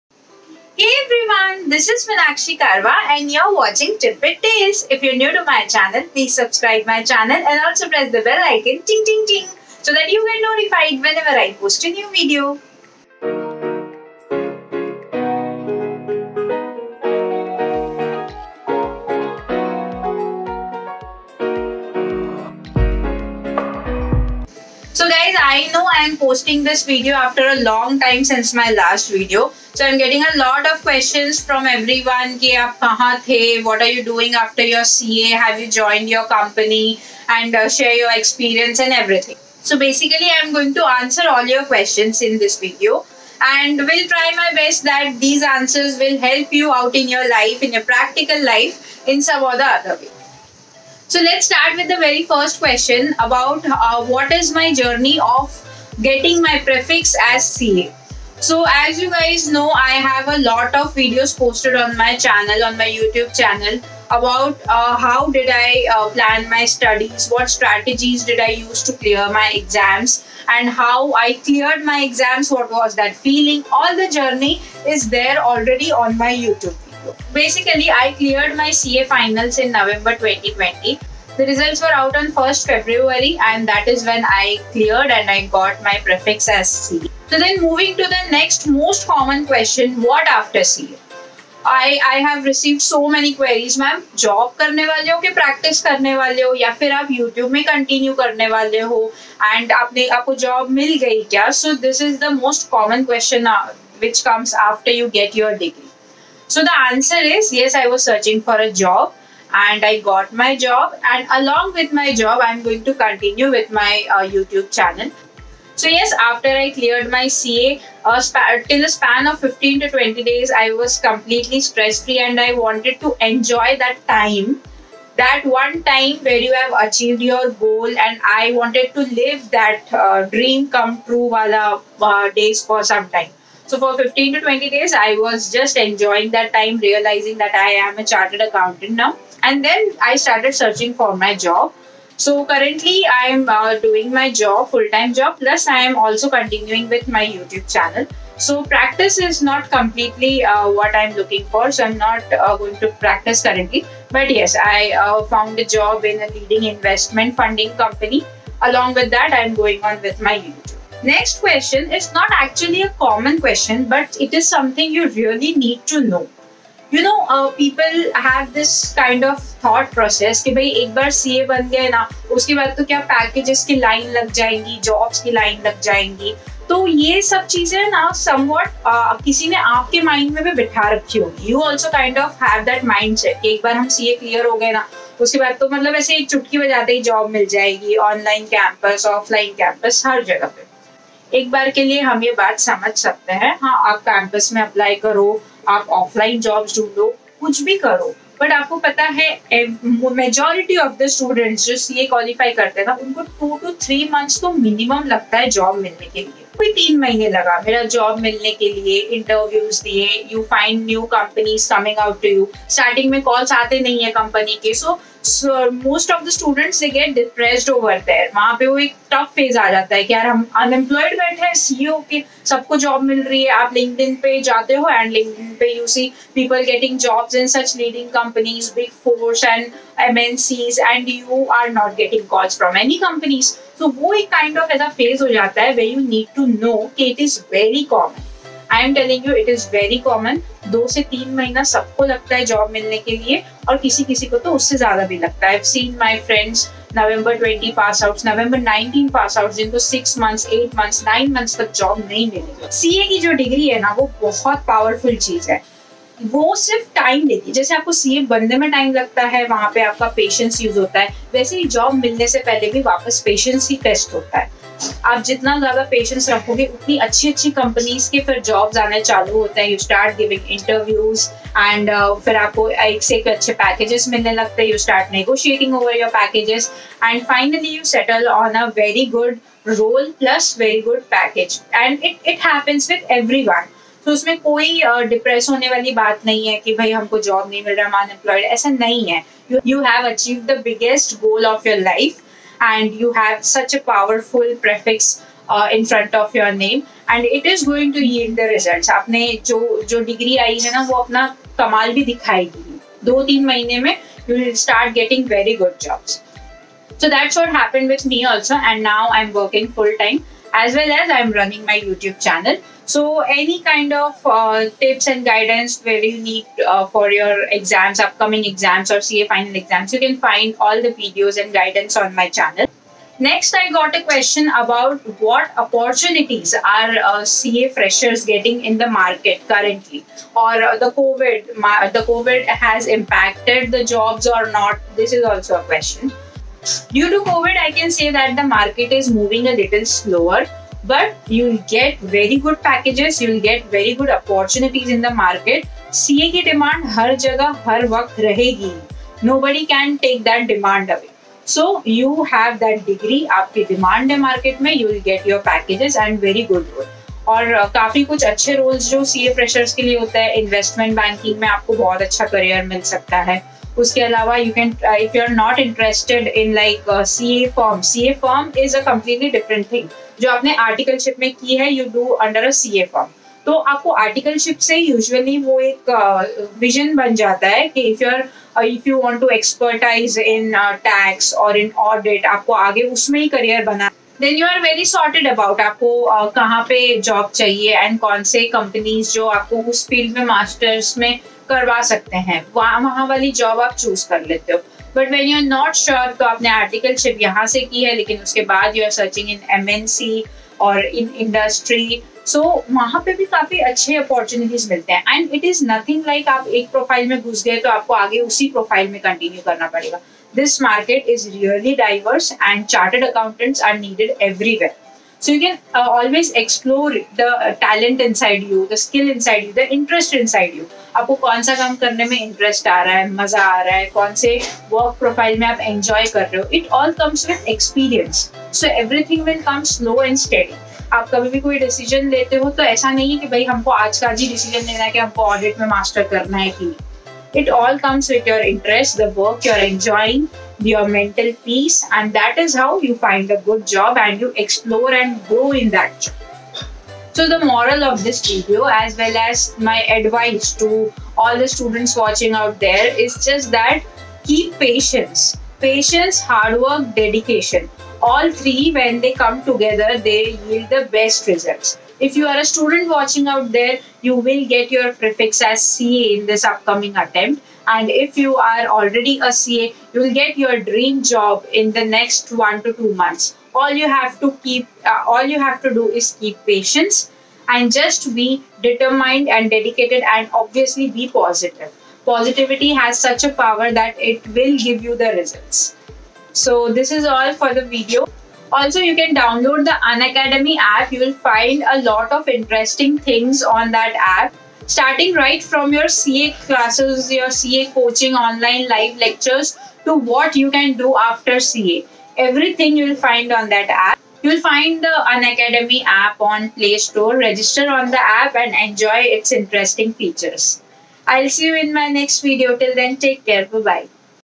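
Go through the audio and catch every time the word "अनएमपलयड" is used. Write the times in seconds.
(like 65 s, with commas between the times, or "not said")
220 s, 288 s.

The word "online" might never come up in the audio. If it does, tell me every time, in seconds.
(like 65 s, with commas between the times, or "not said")
498 s.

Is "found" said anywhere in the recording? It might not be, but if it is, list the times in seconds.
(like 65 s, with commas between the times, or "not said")
155 s.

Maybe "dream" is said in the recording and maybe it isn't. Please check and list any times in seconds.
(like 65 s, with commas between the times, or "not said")
130 s, 470 s.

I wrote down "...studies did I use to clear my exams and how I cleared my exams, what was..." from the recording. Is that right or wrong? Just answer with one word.
wrong.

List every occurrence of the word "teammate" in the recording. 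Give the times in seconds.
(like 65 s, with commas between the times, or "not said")
not said.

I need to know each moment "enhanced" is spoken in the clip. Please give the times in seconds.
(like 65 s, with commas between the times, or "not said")
not said.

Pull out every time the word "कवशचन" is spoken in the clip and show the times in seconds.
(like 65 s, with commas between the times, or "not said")
103 s.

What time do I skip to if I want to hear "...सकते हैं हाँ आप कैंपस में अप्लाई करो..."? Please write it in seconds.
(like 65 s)
192 s.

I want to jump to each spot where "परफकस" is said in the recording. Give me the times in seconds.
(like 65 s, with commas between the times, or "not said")
294 s.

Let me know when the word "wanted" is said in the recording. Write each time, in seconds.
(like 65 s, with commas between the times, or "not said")
122 s, 128 s.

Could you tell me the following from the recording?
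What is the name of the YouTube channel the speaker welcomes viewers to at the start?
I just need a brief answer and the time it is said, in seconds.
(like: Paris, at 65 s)
Tidbit Tales, at 3 s.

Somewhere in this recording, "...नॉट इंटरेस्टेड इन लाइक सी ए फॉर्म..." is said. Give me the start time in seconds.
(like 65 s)
365 s.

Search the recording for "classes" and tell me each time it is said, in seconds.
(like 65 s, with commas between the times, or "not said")
496 s.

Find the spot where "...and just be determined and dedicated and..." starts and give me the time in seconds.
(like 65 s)
477 s.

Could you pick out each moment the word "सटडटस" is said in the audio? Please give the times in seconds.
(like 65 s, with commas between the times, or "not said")
201 s, 216 s.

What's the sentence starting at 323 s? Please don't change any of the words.
Next, I got a question about what opportunities are uh, CA freshers getting in the market currently, or uh, the COVID.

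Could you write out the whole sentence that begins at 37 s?
And uh, share your experience and everything.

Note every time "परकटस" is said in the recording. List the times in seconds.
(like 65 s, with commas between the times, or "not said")
95 s.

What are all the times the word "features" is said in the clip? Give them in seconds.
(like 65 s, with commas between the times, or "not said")
509 s.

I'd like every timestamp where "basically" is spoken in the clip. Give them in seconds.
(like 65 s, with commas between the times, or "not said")
39 s, 77 s.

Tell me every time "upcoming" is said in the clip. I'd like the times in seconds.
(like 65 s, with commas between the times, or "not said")
317 s, 466 s.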